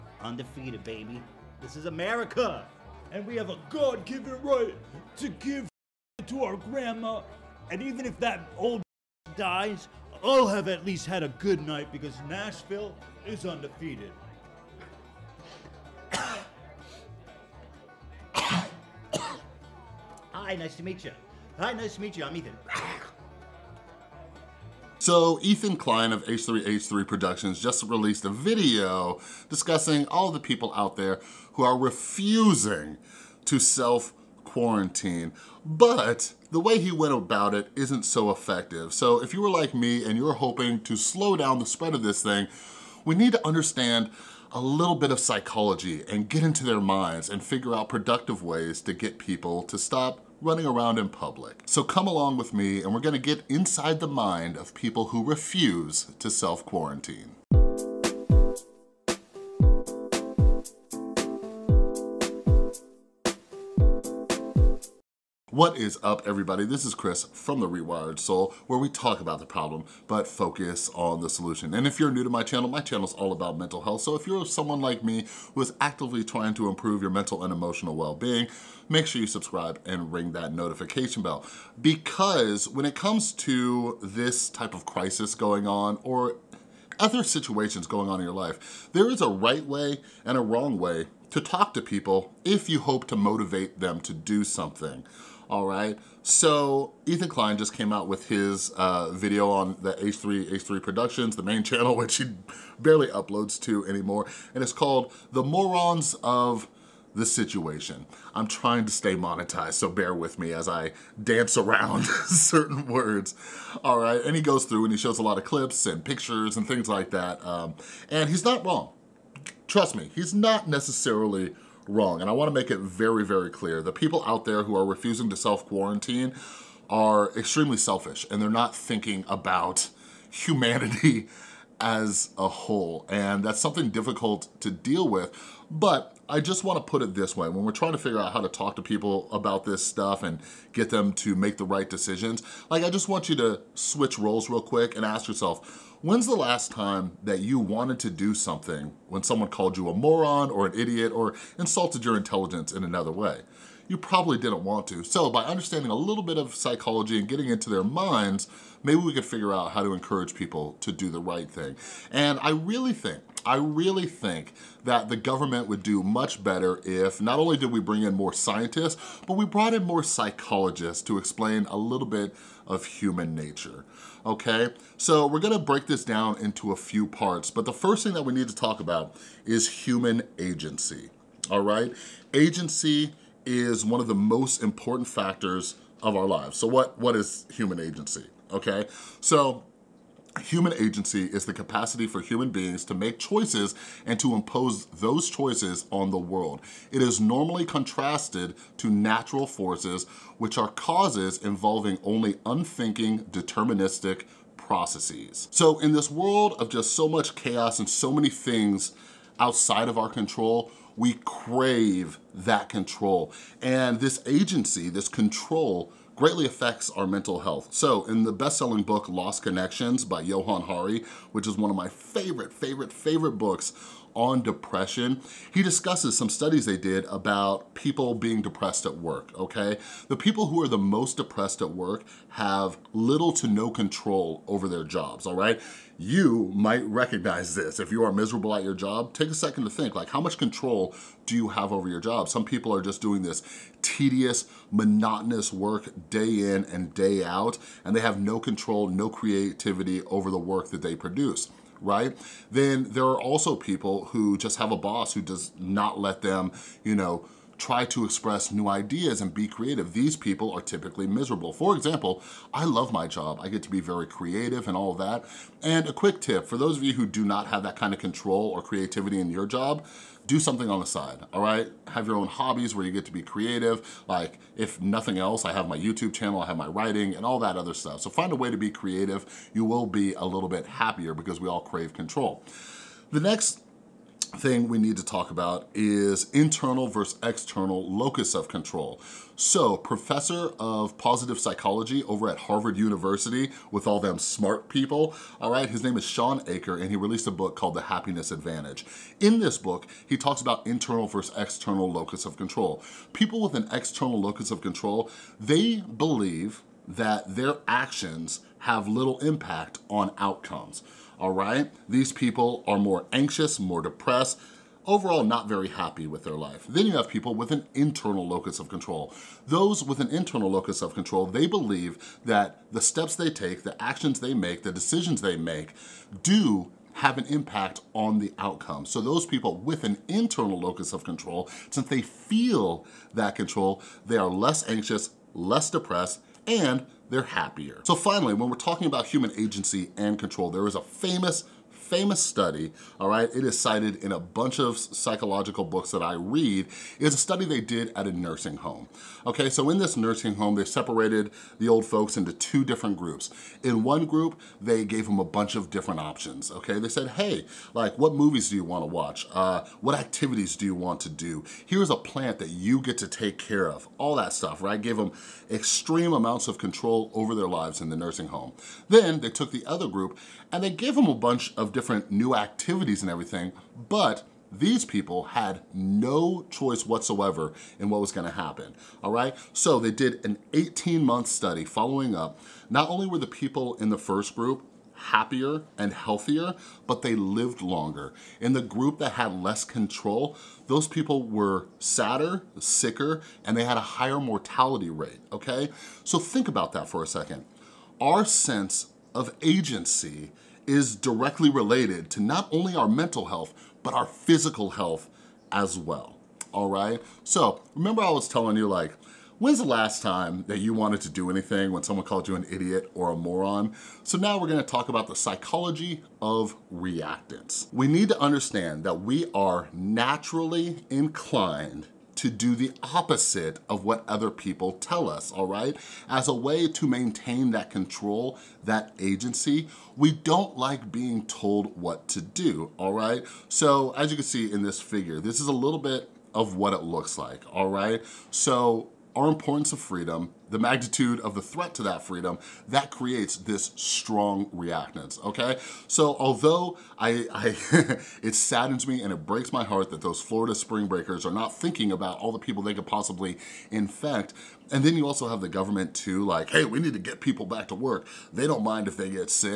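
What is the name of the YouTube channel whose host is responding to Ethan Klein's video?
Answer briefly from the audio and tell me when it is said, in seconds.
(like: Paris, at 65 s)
The Rewired Soul, at 67 s.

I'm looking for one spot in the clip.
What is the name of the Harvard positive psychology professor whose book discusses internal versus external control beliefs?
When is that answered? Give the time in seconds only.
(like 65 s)
296 s.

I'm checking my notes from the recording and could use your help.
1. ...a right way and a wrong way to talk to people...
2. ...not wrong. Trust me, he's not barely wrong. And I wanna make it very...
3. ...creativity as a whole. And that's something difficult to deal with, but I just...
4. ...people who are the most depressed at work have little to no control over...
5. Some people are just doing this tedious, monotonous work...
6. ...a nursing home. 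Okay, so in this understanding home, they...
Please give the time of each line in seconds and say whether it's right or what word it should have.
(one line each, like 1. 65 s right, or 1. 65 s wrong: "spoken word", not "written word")
1. 89 s right
2. 118 s wrong: "necessarily", not "barely"
3. 130 s wrong: "humanity", not "creativity"
4. 230 s right
5. 242 s right
6. 348 s wrong: "nursing", not "understanding".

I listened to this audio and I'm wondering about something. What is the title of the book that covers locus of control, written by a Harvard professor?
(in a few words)
The Happiness Advantage.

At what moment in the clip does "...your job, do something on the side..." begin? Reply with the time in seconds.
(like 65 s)
269 s.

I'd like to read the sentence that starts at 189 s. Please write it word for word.
So Human agency is the capacity for human beings to make choices and to impose those choices on the world.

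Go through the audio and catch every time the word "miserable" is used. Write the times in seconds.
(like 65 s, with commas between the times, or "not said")
238 s, 261 s.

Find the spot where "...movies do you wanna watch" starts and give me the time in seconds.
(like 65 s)
358 s.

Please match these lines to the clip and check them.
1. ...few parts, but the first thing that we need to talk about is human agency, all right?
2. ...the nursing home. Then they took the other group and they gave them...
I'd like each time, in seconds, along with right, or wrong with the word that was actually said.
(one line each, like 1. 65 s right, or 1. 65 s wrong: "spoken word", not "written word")
1. 176 s right
2. 367 s right.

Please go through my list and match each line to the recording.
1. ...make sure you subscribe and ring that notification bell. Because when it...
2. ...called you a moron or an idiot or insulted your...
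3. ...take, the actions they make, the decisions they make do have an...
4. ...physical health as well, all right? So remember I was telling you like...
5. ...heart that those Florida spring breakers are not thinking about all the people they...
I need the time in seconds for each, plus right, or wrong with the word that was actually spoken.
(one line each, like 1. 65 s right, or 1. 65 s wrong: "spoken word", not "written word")
1. 78 s right
2. 149 s right
3. 323 s right
4. 404 s right
5. 449 s right.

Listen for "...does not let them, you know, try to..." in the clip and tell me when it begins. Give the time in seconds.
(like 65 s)
255 s.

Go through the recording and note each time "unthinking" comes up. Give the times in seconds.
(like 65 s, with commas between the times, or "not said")
202 s.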